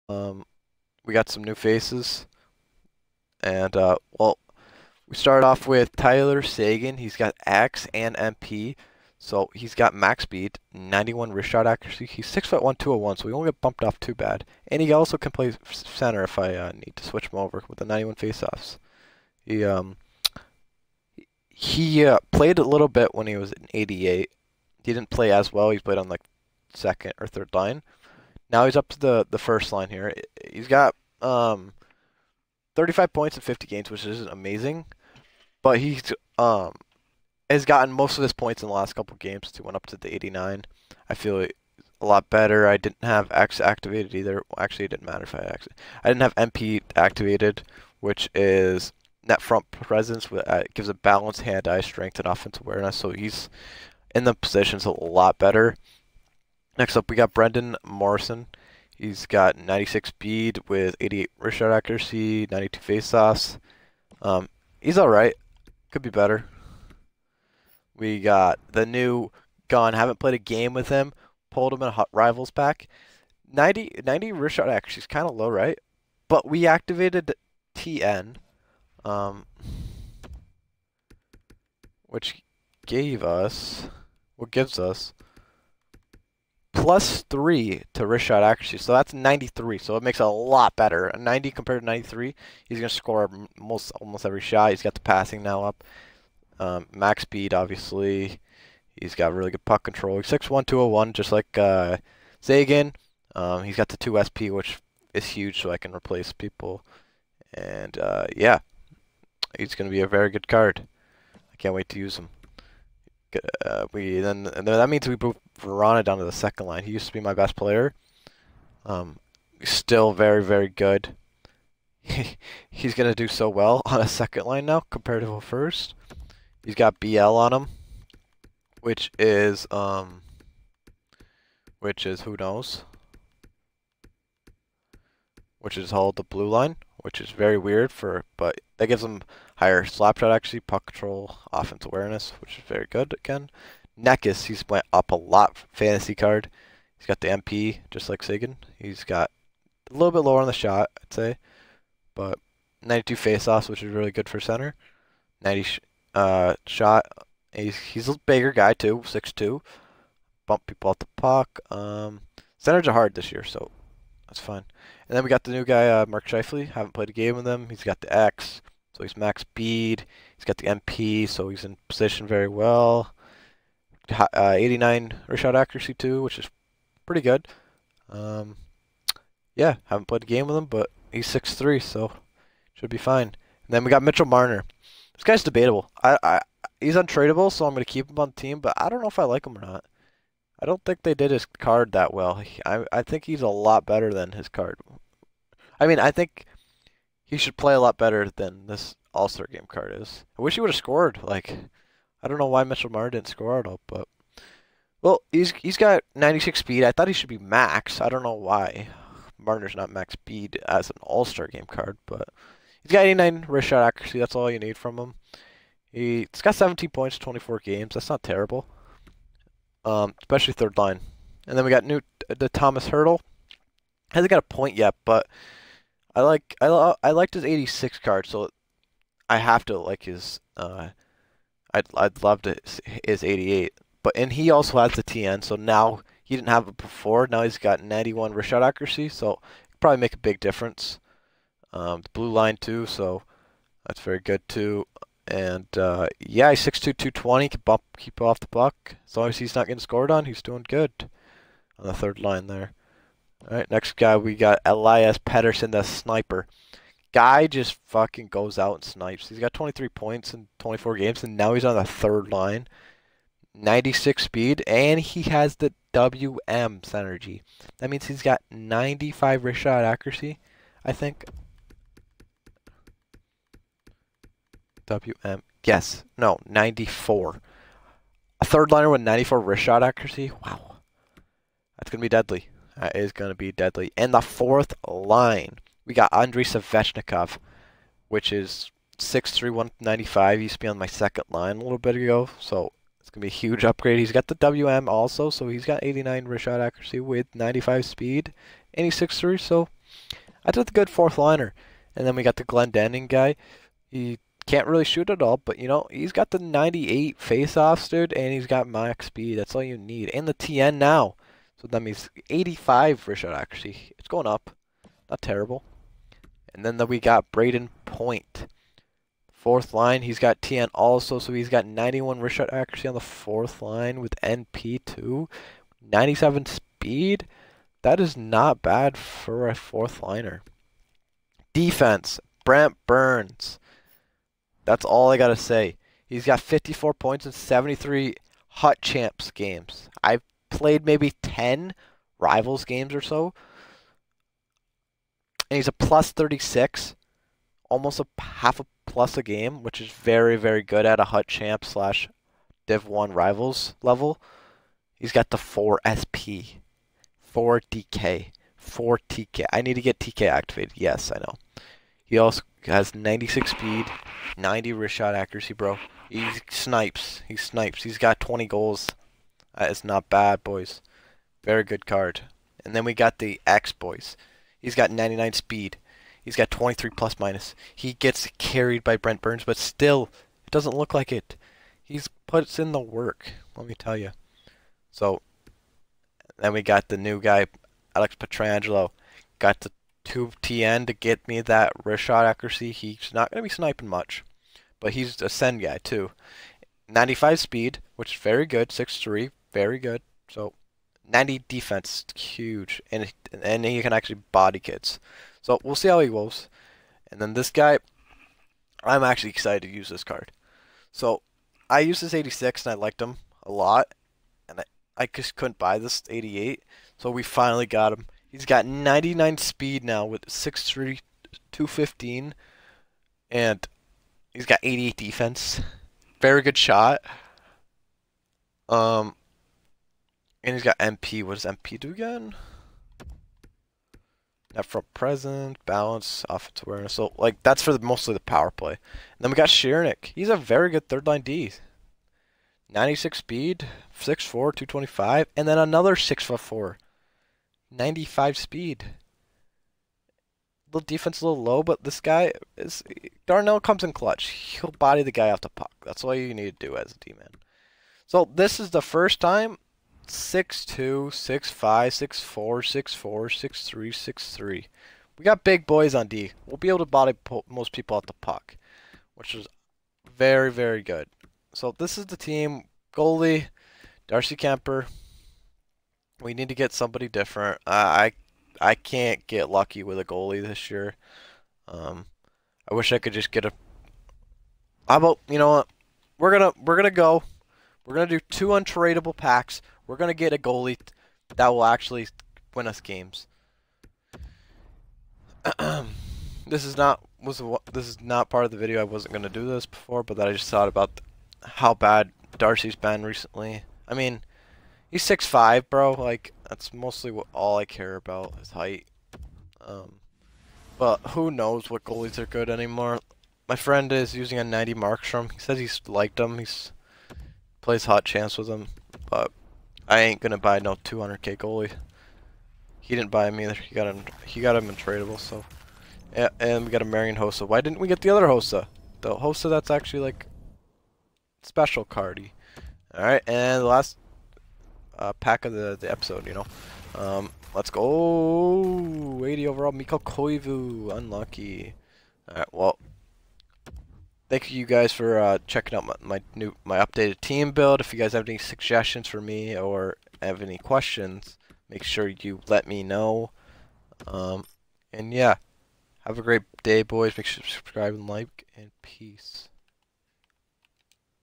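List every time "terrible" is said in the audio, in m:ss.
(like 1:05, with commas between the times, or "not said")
3:38, 5:15.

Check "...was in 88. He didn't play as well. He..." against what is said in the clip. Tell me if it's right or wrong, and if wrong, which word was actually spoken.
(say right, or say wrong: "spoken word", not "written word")
right.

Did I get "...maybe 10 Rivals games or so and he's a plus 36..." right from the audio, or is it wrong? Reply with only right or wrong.
right.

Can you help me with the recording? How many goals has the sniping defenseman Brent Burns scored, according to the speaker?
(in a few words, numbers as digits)
20.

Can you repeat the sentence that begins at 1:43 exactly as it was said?
Um, he's got the 2 SP, which is huge, so I can replace people.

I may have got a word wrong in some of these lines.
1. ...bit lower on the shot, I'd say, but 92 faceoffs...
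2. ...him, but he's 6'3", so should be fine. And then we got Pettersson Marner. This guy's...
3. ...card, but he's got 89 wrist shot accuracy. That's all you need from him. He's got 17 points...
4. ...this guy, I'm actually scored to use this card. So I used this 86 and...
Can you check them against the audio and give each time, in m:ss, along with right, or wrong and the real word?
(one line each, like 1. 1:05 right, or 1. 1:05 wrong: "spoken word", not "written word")
1. 2:30 right
2. 3:00 wrong: "Mitchell", not "Pettersson"
3. 3:31 right
4. 6:47 wrong: "excited", not "scored".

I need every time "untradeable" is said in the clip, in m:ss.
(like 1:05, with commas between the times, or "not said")
3:06, 8:08.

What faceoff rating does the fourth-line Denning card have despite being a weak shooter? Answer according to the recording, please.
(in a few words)
98.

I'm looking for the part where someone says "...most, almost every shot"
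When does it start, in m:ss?
1:33.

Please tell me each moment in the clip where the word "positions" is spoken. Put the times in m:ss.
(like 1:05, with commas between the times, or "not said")
0:54, 2:51.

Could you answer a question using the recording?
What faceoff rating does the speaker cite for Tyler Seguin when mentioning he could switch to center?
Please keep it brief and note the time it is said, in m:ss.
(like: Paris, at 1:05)
91, at 0:17.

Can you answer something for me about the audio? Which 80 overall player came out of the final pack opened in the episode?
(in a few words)
Mikko Koivu.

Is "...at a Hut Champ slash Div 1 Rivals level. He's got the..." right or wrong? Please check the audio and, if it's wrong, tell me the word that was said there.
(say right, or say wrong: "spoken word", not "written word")
right.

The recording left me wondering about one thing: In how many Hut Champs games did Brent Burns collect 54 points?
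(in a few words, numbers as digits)
73.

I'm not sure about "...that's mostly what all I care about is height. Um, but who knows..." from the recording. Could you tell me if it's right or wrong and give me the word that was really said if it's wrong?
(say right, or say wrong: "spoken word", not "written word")
right.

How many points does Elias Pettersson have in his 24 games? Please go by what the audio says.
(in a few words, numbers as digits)
23.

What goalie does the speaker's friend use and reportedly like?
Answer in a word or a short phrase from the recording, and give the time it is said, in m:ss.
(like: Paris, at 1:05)
Markstrom, at 8:34.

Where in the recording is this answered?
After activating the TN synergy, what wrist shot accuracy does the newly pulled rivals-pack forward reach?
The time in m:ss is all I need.
1:28.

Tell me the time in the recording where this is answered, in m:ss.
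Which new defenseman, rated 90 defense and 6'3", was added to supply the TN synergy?
6:27.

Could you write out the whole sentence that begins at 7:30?
Little defense, a little low, but this guy is Darnell comes in clutch.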